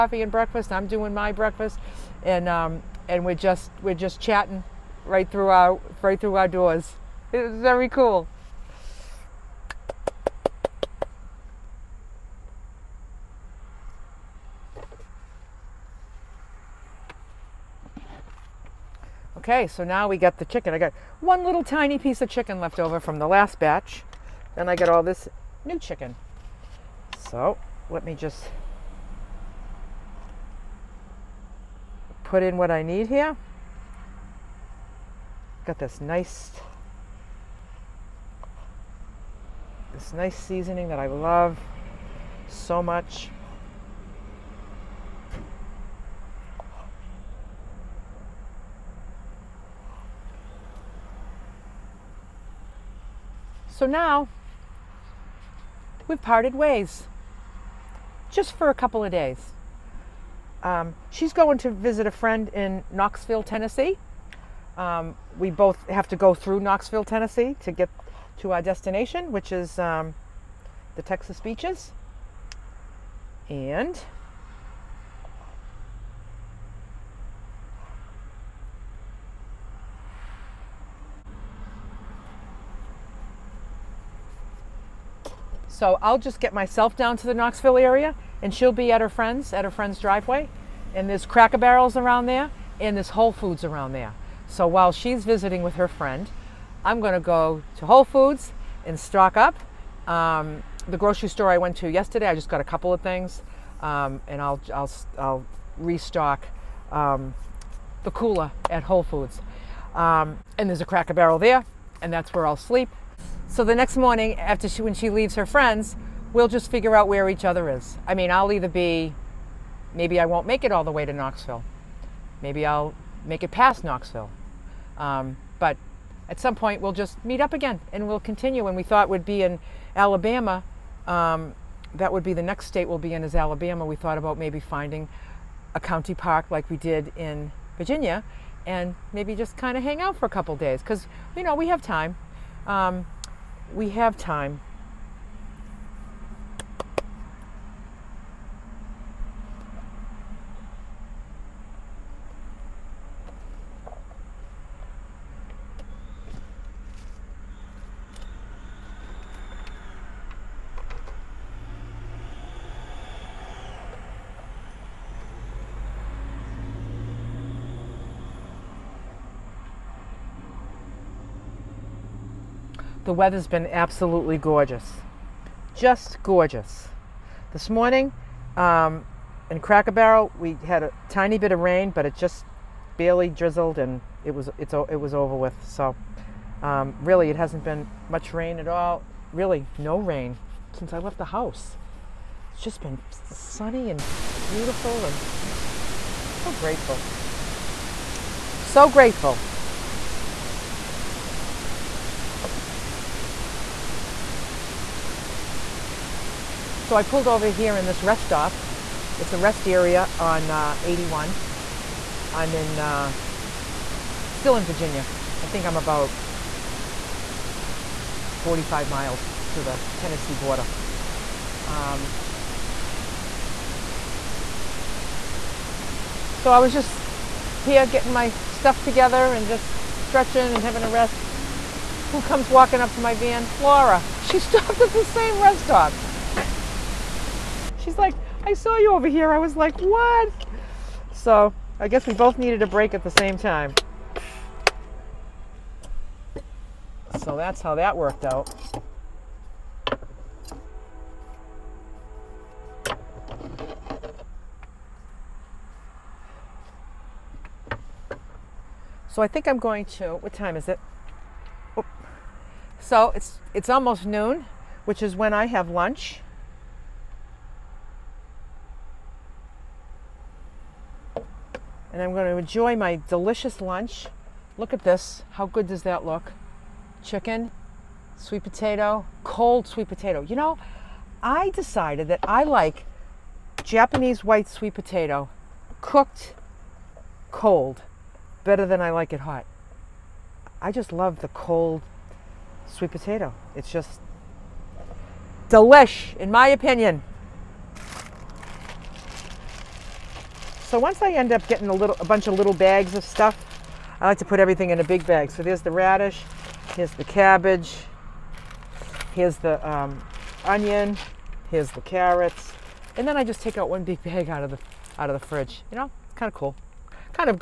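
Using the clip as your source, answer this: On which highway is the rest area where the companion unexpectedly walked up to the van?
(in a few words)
81.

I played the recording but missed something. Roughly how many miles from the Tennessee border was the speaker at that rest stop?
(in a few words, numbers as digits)
45 miles.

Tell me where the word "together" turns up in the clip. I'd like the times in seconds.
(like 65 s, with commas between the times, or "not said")
228 s.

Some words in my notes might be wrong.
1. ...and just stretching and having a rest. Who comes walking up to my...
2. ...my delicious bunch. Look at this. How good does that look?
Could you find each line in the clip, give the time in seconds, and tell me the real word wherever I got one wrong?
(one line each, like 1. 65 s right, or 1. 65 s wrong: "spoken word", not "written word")
1. 229 s right
2. 272 s wrong: "lunch", not "bunch".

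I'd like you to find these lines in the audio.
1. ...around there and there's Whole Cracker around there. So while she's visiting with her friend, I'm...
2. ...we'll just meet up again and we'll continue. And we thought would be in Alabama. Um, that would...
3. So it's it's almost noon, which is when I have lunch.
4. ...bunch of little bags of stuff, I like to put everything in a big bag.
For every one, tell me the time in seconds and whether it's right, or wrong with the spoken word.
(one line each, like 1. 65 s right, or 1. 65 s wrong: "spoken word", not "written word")
1. 91 s wrong: "Foods", not "Cracker"
2. 126 s right
3. 262 s right
4. 302 s right.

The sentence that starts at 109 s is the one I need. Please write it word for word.
Um, and there's a Cracker Barrel there, and that's where I'll sleep.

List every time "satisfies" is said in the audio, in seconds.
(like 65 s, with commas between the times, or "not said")
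not said.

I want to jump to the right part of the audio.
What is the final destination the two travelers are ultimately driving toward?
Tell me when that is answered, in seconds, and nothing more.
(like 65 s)
70 s.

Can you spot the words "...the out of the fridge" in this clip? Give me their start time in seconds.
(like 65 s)
314 s.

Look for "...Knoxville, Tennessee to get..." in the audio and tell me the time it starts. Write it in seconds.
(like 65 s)
66 s.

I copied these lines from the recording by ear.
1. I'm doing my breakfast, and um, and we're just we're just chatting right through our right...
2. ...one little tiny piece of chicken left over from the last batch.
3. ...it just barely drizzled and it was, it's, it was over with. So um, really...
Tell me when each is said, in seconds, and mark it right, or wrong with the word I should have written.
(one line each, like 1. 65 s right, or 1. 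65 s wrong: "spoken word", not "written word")
1. 0 s right
2. 21 s right
3. 182 s right.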